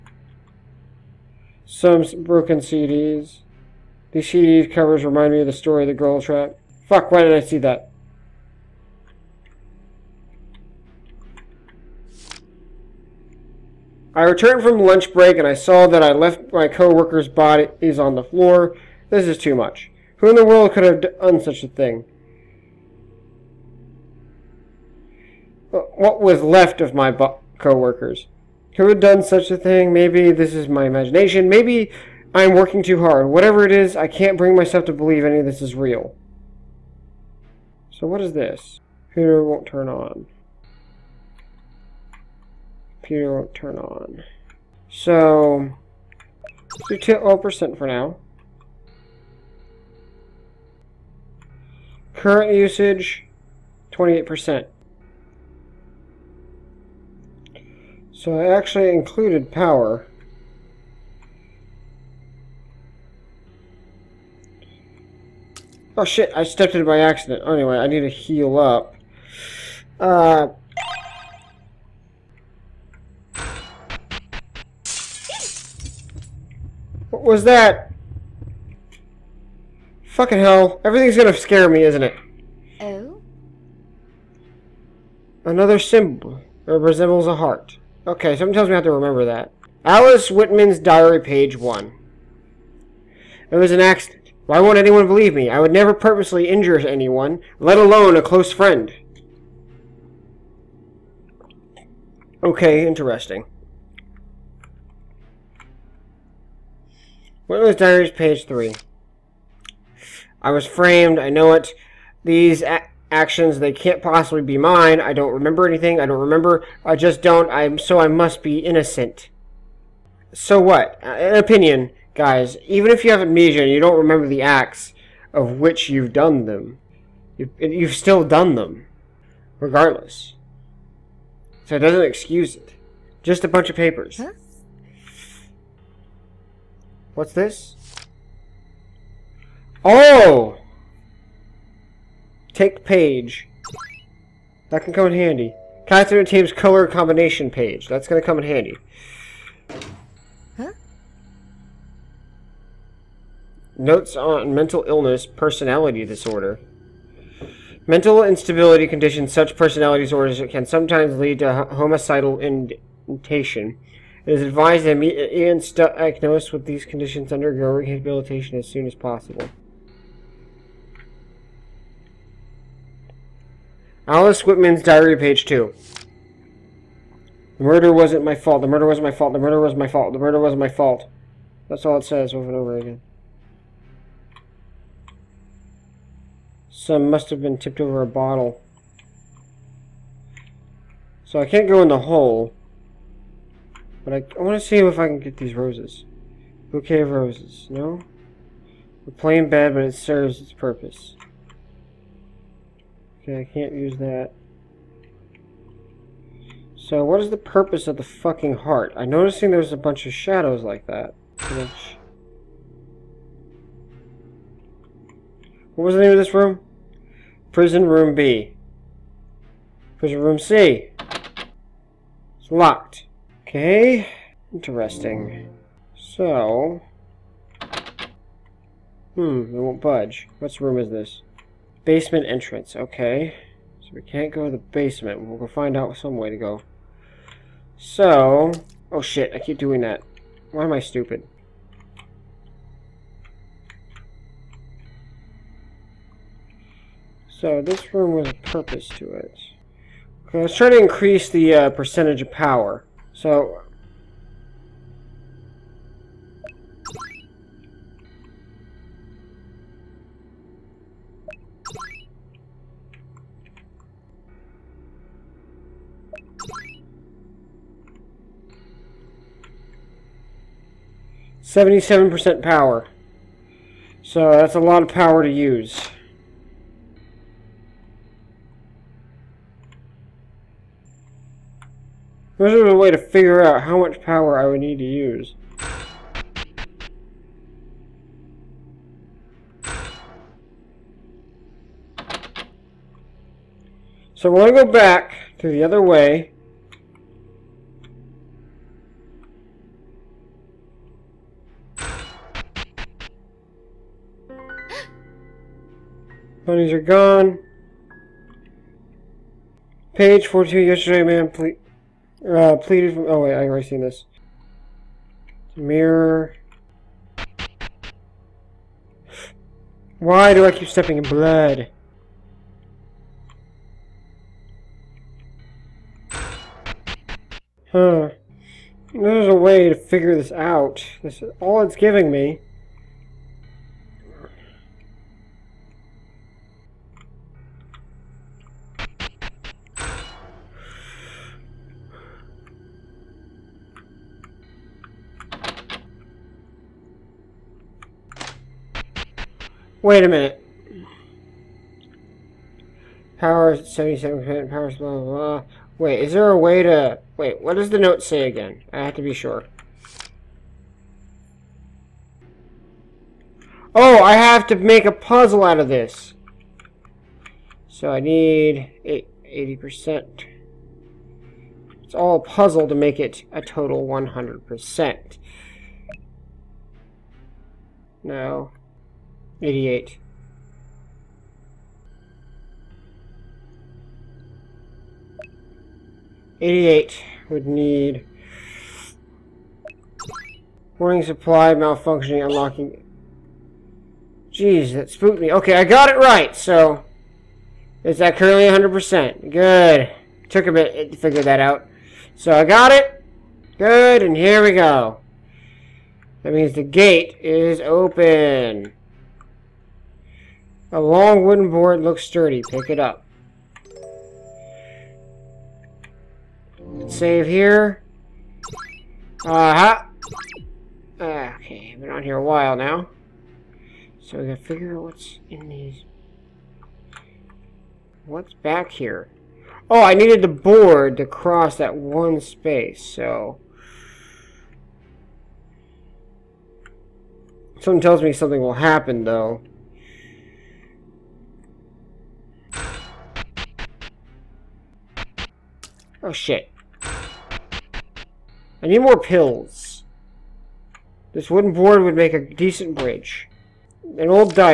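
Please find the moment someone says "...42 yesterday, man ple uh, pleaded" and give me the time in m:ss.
5:10.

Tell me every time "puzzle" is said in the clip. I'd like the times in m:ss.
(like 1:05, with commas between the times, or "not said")
6:04, 6:12.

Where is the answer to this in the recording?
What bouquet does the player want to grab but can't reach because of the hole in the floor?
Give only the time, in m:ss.
3:16.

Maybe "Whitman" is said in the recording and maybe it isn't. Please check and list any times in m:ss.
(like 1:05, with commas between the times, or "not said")
1:30, 1:47, 2:54.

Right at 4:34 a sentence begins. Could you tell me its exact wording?
So that's a lot of power to use.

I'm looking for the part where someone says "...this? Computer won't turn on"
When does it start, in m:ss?
0:38.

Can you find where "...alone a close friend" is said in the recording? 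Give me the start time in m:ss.
1:37.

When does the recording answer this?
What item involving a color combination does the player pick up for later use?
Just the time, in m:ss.
2:25.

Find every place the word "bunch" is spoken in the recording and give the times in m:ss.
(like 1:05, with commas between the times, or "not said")
2:13, 3:29.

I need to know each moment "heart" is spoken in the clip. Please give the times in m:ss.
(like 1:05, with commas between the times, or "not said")
1:27, 3:28.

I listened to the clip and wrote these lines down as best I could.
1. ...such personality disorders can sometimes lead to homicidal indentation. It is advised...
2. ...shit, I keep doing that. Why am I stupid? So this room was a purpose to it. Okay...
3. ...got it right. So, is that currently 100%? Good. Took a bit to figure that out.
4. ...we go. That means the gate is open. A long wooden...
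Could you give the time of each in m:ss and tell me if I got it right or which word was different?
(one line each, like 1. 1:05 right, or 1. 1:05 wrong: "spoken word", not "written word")
1. 2:39 right
2. 3:59 right
3. 6:35 right
4. 6:44 right.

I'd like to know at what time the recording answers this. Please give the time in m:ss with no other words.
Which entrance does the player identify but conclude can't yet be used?
3:51.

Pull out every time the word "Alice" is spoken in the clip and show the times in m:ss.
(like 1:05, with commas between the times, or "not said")
1:29, 2:54.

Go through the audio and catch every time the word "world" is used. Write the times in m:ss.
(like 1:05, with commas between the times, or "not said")
0:20.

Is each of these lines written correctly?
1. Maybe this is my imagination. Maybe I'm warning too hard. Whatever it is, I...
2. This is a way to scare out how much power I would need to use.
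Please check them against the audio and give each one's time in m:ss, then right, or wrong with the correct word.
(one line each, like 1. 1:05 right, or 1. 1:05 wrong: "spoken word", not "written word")
1. 0:29 wrong: "working", not "warning"
2. 4:42 wrong: "figure", not "scare".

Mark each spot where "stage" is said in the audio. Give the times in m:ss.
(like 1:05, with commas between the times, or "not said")
not said.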